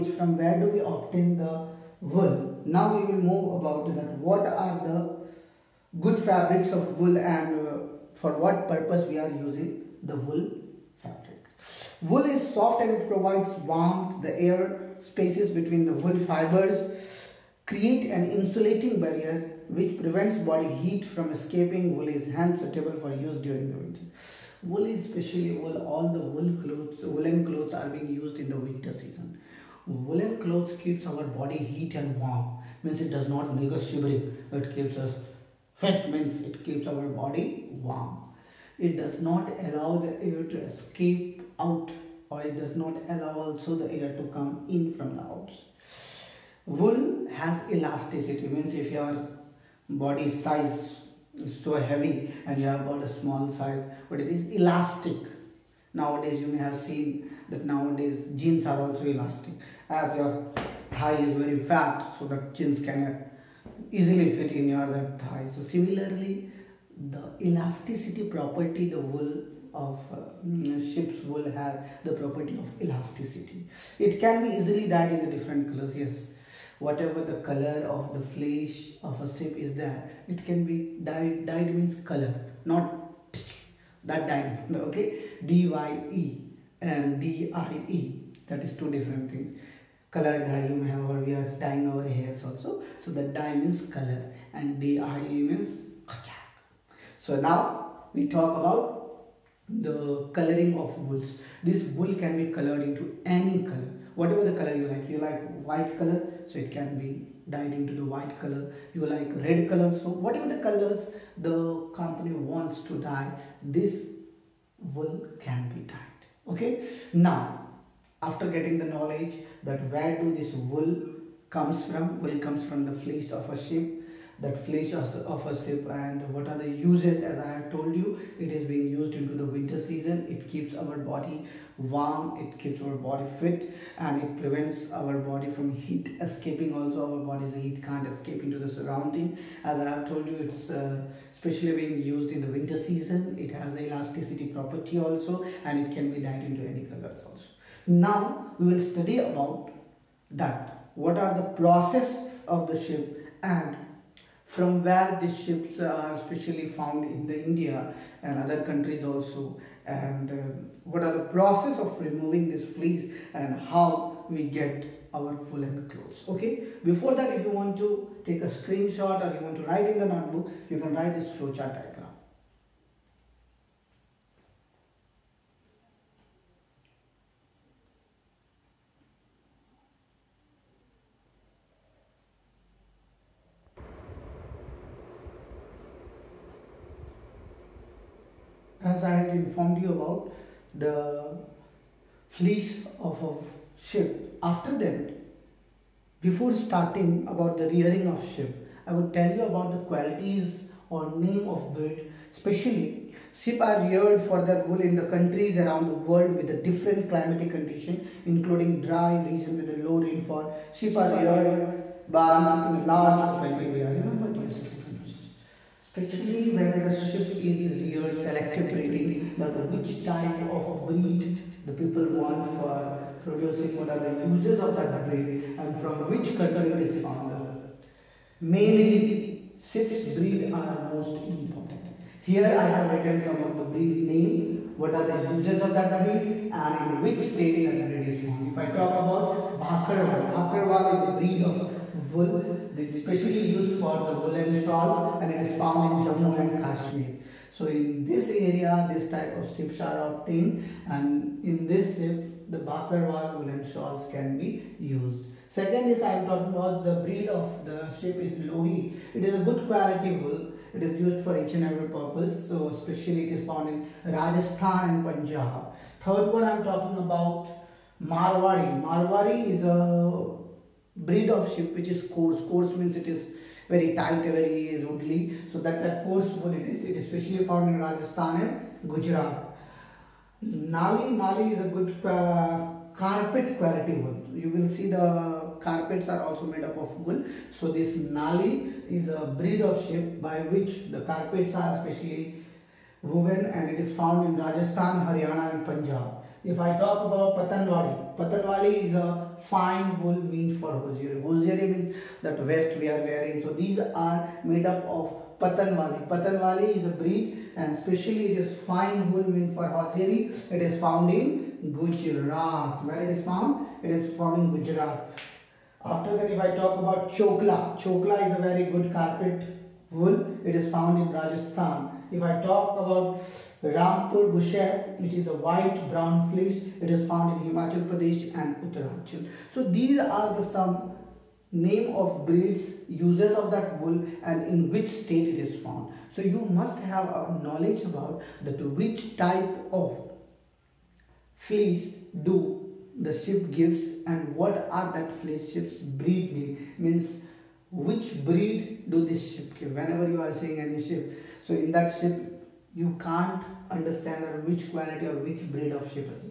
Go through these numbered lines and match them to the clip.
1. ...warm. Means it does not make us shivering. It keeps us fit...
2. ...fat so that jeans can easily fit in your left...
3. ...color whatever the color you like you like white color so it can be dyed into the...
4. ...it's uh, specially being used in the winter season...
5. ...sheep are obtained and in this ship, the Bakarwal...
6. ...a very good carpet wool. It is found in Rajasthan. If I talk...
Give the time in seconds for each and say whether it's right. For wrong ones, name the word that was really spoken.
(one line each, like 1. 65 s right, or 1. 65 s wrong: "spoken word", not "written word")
1. 32 s right
2. 61 s right
3. 103 s right
4. 140 s wrong: "especially", not "specially"
5. 249 s right
6. 318 s right.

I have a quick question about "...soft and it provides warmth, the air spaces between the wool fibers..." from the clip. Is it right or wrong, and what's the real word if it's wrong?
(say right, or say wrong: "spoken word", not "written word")
right.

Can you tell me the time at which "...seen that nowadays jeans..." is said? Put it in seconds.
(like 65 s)
56 s.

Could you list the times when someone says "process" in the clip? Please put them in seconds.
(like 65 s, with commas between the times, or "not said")
151 s, 161 s.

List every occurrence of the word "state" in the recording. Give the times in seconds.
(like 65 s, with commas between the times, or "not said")
237 s, 334 s.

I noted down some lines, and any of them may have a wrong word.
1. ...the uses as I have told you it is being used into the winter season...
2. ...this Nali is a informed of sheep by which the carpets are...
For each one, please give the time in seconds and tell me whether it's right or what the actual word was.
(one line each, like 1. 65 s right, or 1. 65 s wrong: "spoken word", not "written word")
1. 126 s right
2. 287 s wrong: "breed", not "informed".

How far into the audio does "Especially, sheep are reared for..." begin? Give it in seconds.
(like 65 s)
202 s.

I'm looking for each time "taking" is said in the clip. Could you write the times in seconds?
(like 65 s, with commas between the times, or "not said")
not said.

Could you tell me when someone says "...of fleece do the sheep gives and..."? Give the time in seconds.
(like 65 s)
339 s.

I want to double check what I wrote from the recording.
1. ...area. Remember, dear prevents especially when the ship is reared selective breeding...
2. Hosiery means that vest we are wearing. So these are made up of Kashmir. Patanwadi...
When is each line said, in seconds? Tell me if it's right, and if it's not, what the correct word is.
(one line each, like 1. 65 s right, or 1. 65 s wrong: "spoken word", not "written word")
1. 213 s wrong: "students", not "prevents"
2. 301 s wrong: "Patanwadi", not "Kashmir".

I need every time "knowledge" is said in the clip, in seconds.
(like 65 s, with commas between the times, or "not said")
118 s, 337 s.